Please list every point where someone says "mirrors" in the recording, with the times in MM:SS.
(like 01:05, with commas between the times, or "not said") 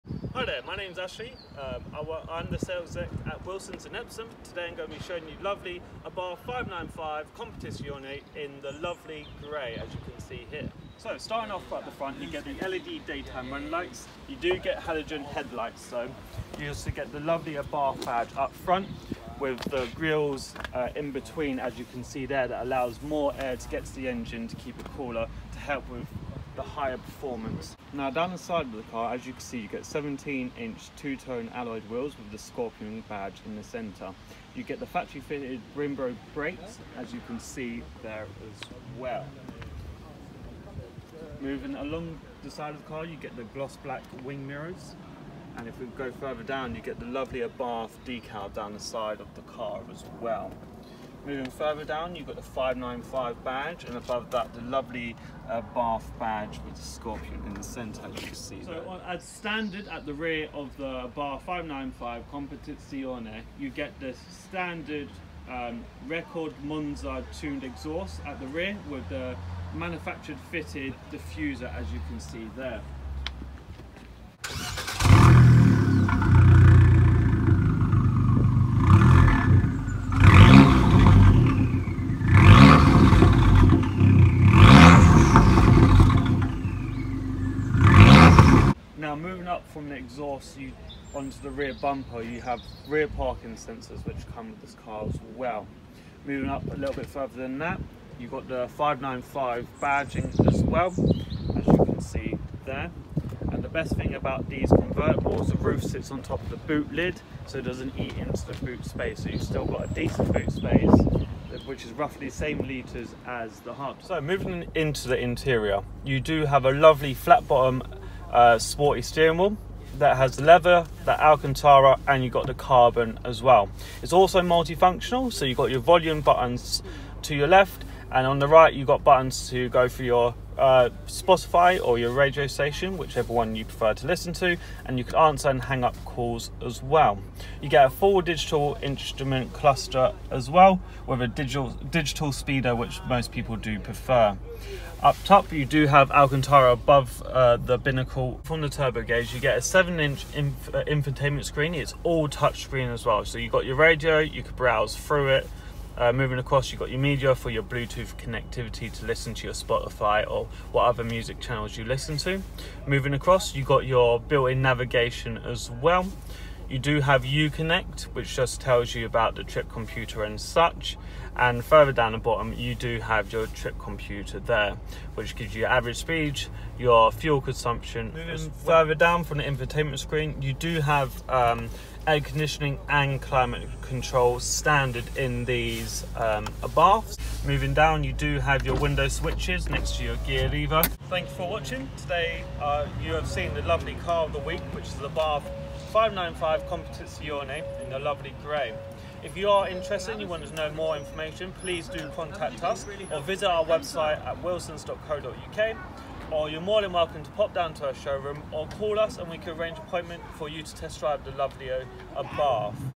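00:44.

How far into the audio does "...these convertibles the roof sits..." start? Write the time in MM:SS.
01:44.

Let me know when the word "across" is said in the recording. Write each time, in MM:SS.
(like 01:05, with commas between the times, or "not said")
02:36, 02:43.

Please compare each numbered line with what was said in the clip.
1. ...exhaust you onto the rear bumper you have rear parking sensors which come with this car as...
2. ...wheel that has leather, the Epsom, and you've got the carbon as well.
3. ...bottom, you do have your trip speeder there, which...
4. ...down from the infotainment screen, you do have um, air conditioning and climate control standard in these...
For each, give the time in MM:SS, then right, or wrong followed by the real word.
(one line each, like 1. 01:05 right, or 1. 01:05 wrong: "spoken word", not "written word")
1. 01:29 right
2. 01:59 wrong: "Alcantara", not "Epsom"
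3. 02:52 wrong: "computer", not "speeder"
4. 02:58 right.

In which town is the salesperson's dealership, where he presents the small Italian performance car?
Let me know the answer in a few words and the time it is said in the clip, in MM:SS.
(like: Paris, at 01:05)
Epsom, at 00:03.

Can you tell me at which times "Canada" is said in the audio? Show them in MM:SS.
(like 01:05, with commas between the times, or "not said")
not said.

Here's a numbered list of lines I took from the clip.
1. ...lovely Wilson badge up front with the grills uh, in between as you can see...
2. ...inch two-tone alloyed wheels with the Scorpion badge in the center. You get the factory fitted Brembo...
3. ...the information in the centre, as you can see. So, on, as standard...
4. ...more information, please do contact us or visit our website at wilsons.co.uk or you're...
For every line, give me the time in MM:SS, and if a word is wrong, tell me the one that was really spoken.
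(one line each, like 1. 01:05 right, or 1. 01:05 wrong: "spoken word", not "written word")
1. 00:17 wrong: "Abarth", not "Wilson"
2. 00:30 right
3. 00:56 wrong: "scorpion", not "information"
4. 03:20 right.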